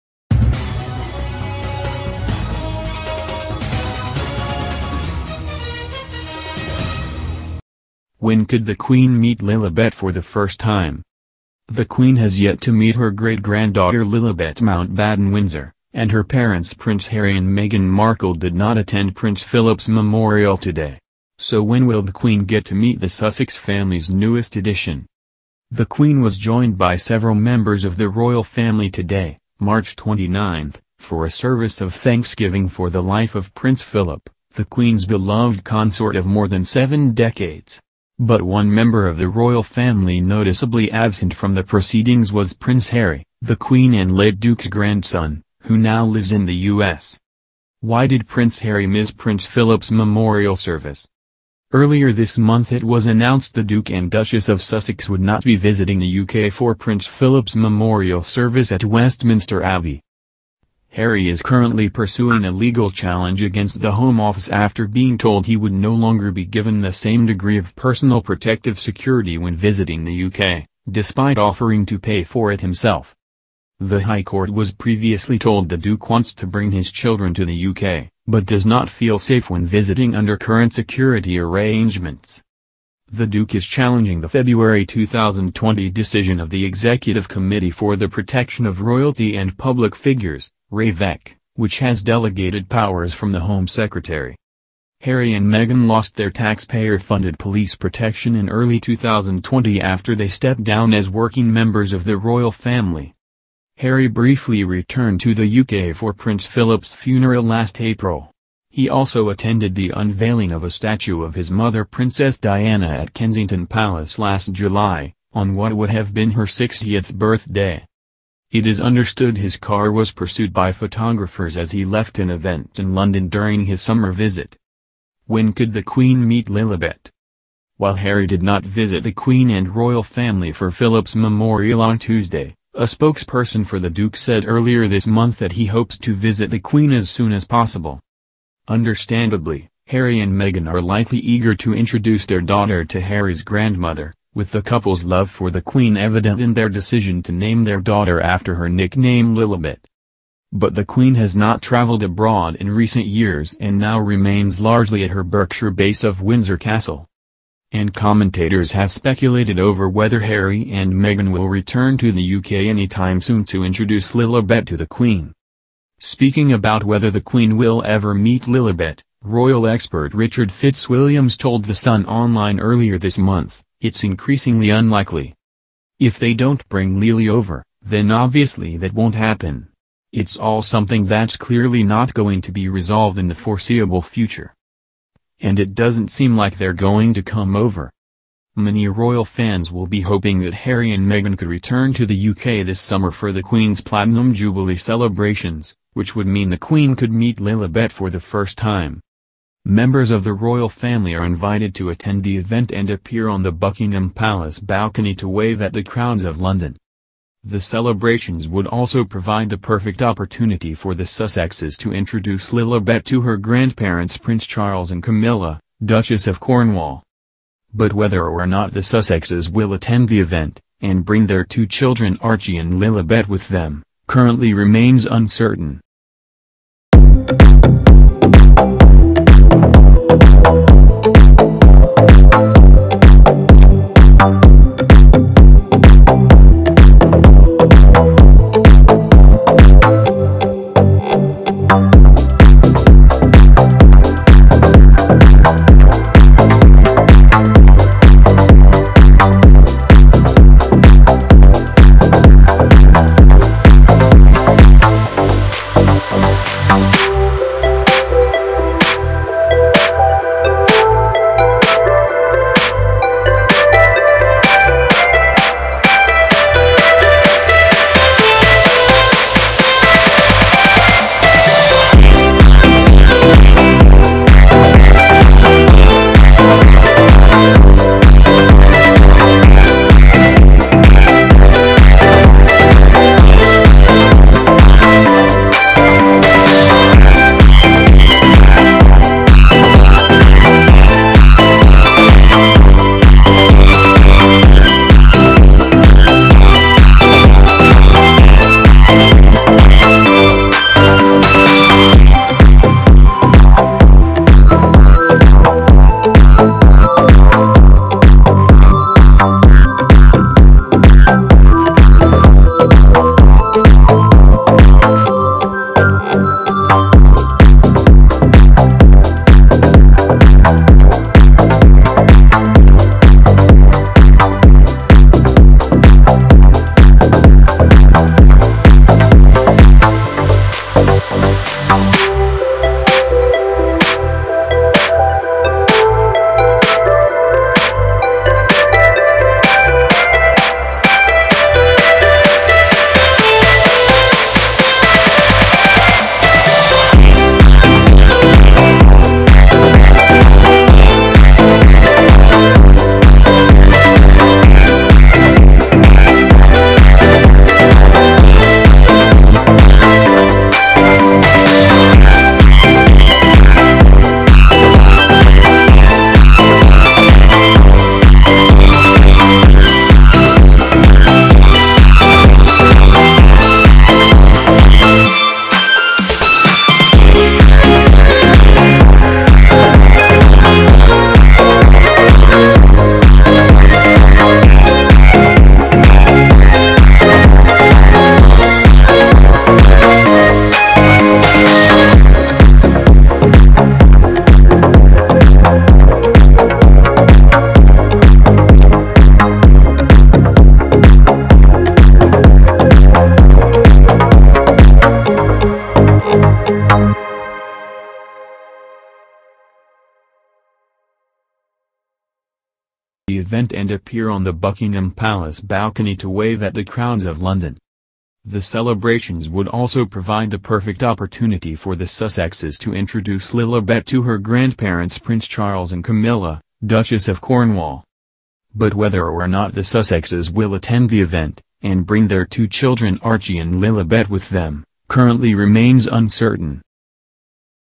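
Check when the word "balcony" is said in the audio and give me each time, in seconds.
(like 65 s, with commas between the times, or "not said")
204 s, 415 s.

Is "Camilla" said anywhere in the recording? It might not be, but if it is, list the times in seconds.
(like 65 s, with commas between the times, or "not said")
215 s, 425 s.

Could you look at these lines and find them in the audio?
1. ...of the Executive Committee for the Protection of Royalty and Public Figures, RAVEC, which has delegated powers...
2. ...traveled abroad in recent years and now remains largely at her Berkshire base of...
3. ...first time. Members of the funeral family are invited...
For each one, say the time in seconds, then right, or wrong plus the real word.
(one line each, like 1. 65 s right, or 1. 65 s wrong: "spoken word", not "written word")
1. 86 s right
2. 151 s right
3. 198 s wrong: "royal", not "funeral".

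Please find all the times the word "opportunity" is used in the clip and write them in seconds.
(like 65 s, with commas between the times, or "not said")
210 s, 420 s.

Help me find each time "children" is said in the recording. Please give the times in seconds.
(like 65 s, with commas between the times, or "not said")
76 s, 221 s, 432 s.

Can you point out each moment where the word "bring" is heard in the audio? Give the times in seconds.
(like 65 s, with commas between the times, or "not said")
76 s, 176 s, 221 s, 431 s.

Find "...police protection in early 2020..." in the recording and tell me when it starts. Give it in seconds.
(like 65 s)
97 s.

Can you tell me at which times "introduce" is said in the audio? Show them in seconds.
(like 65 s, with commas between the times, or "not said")
141 s, 163 s, 211 s, 422 s.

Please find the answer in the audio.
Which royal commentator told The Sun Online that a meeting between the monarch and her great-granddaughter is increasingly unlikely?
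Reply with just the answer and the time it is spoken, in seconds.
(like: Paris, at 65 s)
Richard Fitzwilliams, at 170 s.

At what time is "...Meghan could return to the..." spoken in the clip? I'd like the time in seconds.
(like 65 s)
191 s.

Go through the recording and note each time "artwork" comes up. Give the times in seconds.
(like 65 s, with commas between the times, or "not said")
not said.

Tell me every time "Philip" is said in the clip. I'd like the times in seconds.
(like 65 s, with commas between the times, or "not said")
19 s, 33 s, 49 s, 57 s, 106 s, 130 s.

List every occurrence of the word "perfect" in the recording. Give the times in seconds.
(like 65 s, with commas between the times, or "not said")
209 s, 420 s.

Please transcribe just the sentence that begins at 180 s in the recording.
It's all something that's clearly not going to be resolved in the foreseeable future.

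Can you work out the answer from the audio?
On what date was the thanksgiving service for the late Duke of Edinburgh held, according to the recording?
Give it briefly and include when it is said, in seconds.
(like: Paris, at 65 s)
March 29, at 29 s.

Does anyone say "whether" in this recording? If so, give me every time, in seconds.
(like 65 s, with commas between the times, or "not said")
159 s, 166 s, 217 s, 428 s.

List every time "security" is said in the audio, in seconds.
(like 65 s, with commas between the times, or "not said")
68 s, 80 s.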